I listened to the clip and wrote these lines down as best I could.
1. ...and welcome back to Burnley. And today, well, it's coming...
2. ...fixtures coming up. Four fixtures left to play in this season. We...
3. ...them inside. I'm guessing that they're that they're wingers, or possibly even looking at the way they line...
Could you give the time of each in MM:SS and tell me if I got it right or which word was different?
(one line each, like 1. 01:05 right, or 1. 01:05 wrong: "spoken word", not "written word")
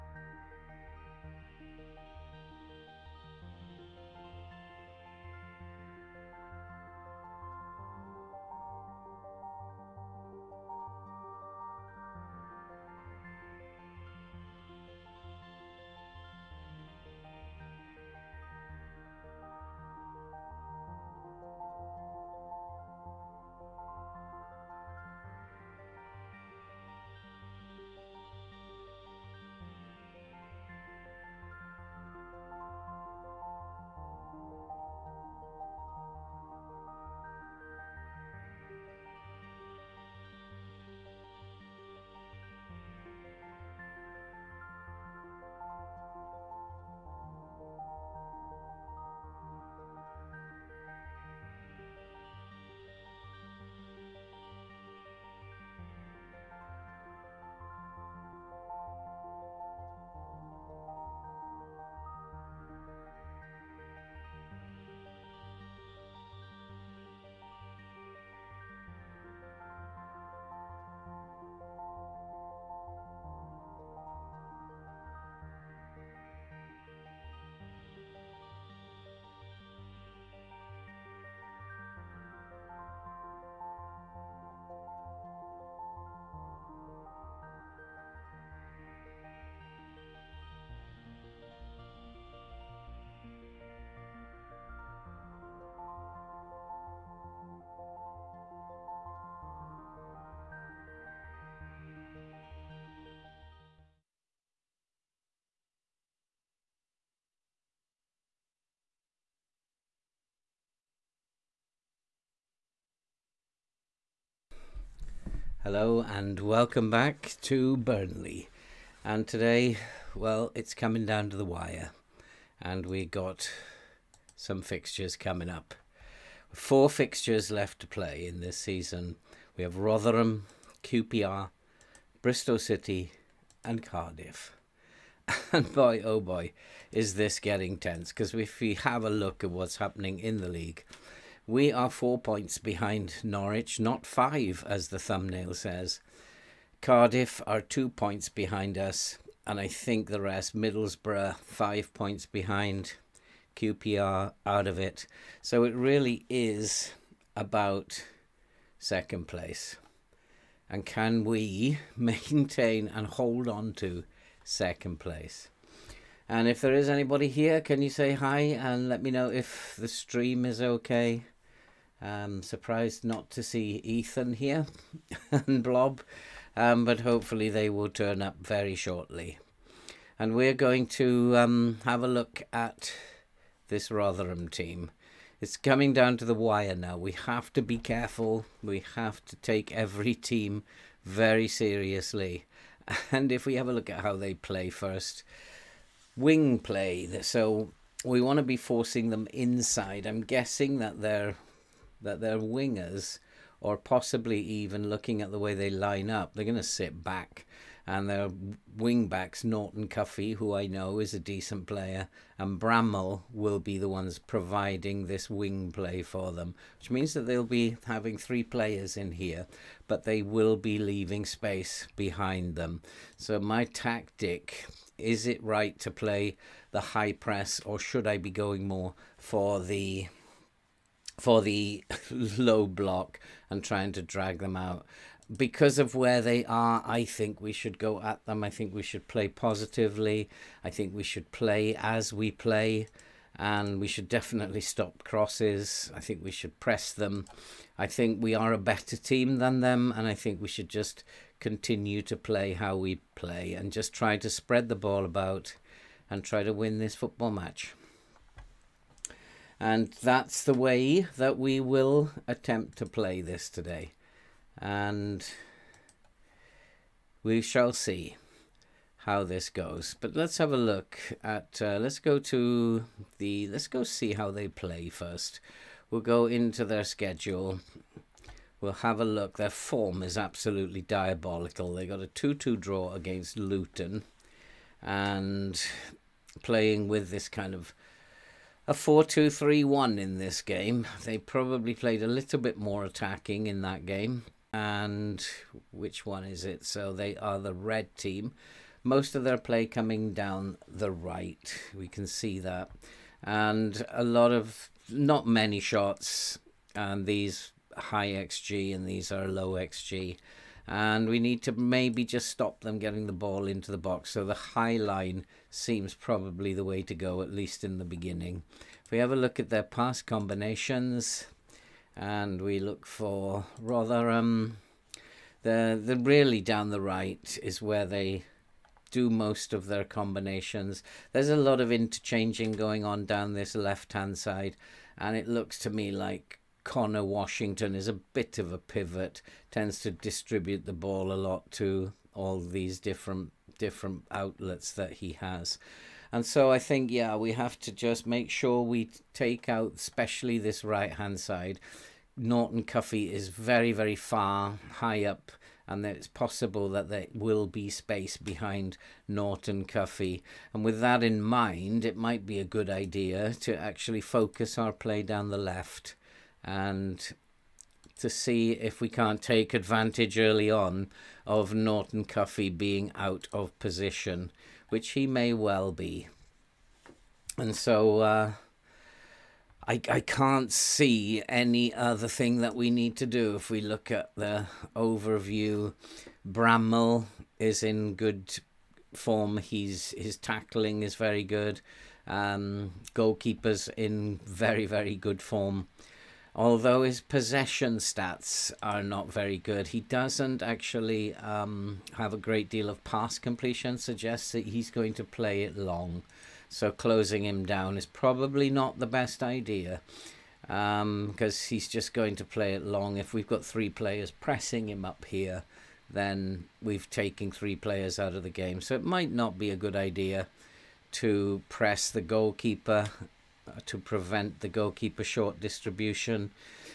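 1. 01:56 right
2. 02:04 right
3. 03:19 right.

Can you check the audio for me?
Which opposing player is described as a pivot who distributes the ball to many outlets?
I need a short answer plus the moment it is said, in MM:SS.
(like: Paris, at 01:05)
Connor Washington, at 05:36.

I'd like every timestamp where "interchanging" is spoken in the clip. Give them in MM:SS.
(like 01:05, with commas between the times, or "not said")
05:31.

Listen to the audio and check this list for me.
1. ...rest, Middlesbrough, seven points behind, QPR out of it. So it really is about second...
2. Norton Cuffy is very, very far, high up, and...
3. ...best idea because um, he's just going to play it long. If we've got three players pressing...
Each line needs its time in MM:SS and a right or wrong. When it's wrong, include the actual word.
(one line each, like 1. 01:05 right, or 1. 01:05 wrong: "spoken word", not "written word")
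1. 02:30 wrong: "five", not "seven"
2. 05:52 right
3. 06:48 right.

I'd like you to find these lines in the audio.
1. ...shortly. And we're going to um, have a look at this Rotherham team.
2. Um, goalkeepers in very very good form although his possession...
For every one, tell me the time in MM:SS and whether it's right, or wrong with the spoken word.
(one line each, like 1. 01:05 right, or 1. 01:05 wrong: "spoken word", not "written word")
1. 02:58 right
2. 06:32 right.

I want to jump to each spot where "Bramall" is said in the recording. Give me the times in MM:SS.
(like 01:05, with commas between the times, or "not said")
03:32, 06:26.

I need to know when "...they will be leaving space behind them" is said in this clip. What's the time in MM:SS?
03:40.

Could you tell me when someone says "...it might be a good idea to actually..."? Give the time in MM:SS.
06:01.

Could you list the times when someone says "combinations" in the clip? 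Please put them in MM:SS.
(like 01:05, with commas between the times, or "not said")
05:20, 05:29.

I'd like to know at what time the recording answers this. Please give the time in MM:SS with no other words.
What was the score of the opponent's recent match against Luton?
04:42.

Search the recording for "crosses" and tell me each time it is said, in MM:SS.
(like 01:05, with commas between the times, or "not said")
04:05.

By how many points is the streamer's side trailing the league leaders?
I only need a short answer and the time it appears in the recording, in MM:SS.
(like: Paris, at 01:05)
4, at 02:21.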